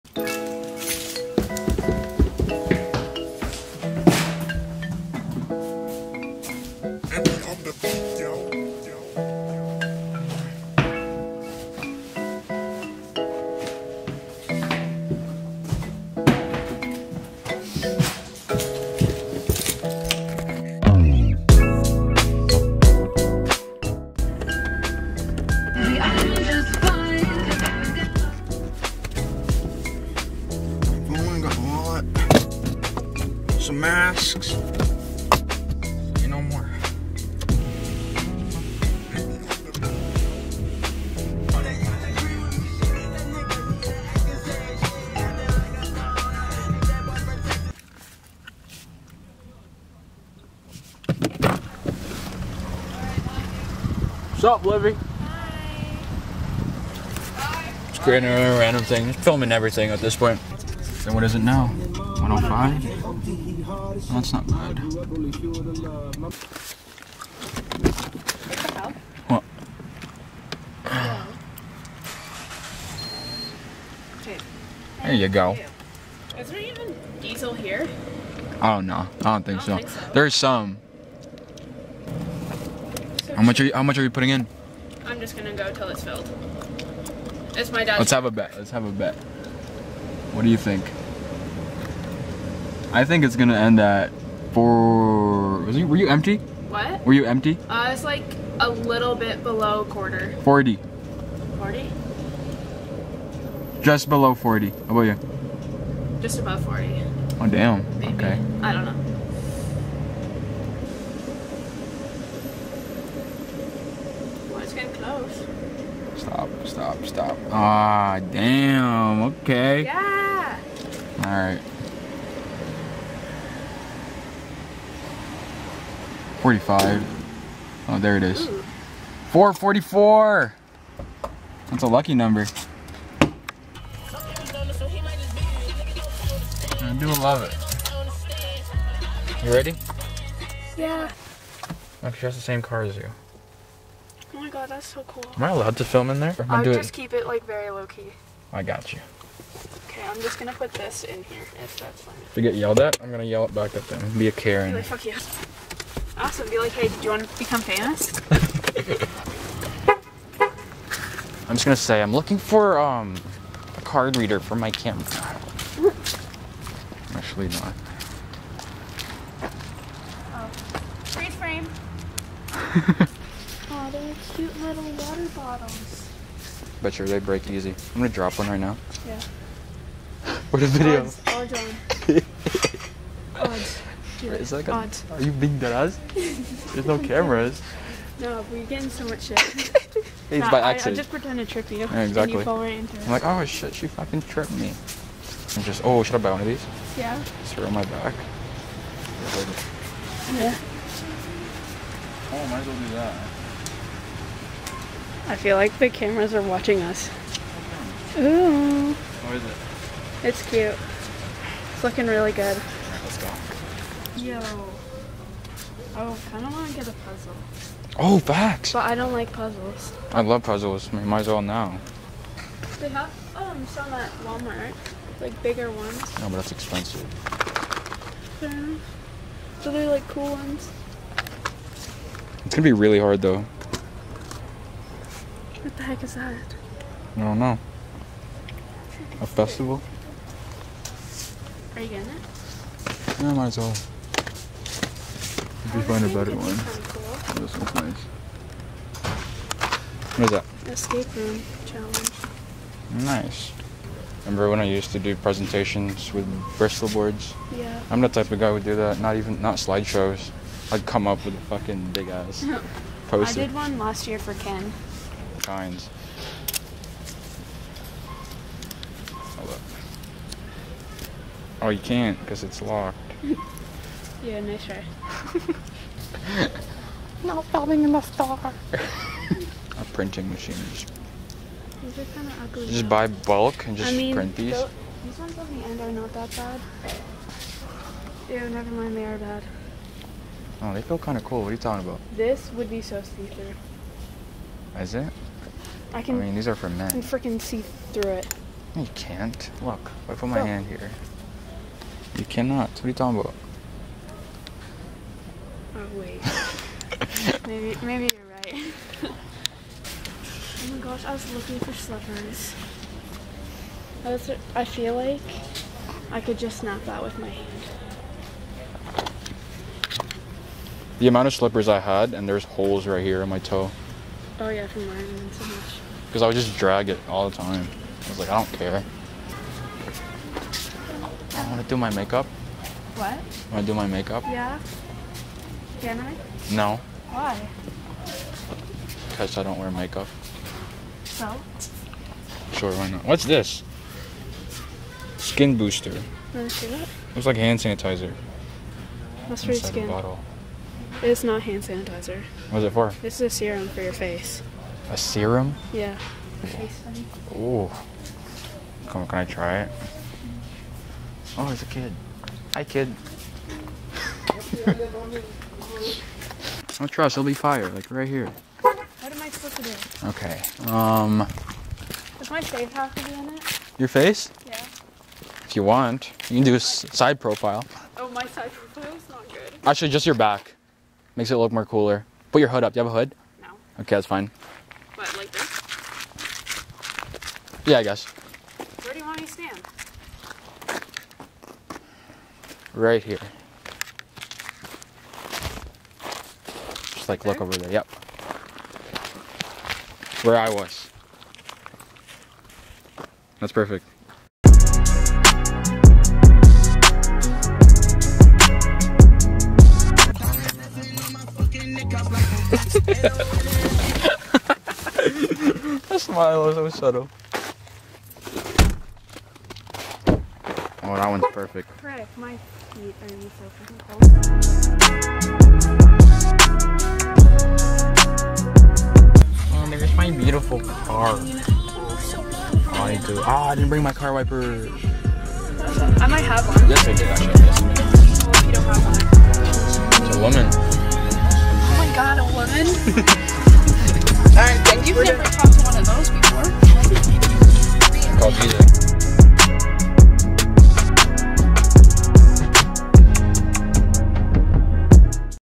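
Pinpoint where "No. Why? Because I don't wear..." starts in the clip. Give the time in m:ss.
5:36.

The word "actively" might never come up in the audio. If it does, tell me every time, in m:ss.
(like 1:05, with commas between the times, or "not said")
not said.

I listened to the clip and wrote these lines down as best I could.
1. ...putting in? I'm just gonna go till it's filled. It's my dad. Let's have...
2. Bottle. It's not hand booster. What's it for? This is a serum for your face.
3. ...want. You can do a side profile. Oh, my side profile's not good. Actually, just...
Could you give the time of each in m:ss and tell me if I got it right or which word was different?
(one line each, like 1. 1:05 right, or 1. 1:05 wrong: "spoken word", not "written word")
1. 1:24 right
2. 5:49 wrong: "sanitizer", not "booster"
3. 6:15 right.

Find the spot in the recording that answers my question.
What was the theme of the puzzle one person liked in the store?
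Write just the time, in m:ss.
4:10.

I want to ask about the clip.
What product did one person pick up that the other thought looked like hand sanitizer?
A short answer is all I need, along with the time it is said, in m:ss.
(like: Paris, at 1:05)
Skin booster, at 5:45.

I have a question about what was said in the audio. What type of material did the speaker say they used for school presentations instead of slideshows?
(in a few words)
Bristol boards.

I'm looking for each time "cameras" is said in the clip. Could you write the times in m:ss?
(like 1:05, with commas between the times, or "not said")
2:44, 3:06, 3:25.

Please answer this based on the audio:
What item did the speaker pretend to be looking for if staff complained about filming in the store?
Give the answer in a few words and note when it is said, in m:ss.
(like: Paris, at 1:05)
a card reader, at 2:43.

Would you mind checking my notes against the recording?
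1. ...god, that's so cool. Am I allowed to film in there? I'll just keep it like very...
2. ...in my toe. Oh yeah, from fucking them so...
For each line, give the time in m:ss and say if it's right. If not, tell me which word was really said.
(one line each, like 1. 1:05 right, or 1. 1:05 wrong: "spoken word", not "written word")
1. 2:24 right
2. 5:23 wrong: "wearing", not "fucking".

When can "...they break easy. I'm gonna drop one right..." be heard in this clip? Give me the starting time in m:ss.
2:57.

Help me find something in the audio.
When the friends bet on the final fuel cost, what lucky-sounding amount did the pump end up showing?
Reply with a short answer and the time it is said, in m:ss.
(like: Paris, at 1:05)
444, at 2:09.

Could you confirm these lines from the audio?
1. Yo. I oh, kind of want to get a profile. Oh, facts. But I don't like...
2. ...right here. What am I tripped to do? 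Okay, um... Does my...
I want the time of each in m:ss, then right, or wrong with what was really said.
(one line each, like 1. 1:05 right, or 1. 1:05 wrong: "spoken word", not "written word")
1. 3:34 wrong: "puzzle", not "profile"
2. 6:07 wrong: "supposed", not "tripped".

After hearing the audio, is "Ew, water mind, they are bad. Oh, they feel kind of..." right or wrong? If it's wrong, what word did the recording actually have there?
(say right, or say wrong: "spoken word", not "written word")
wrong: "never", not "water".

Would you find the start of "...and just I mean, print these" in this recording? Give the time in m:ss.
4:43.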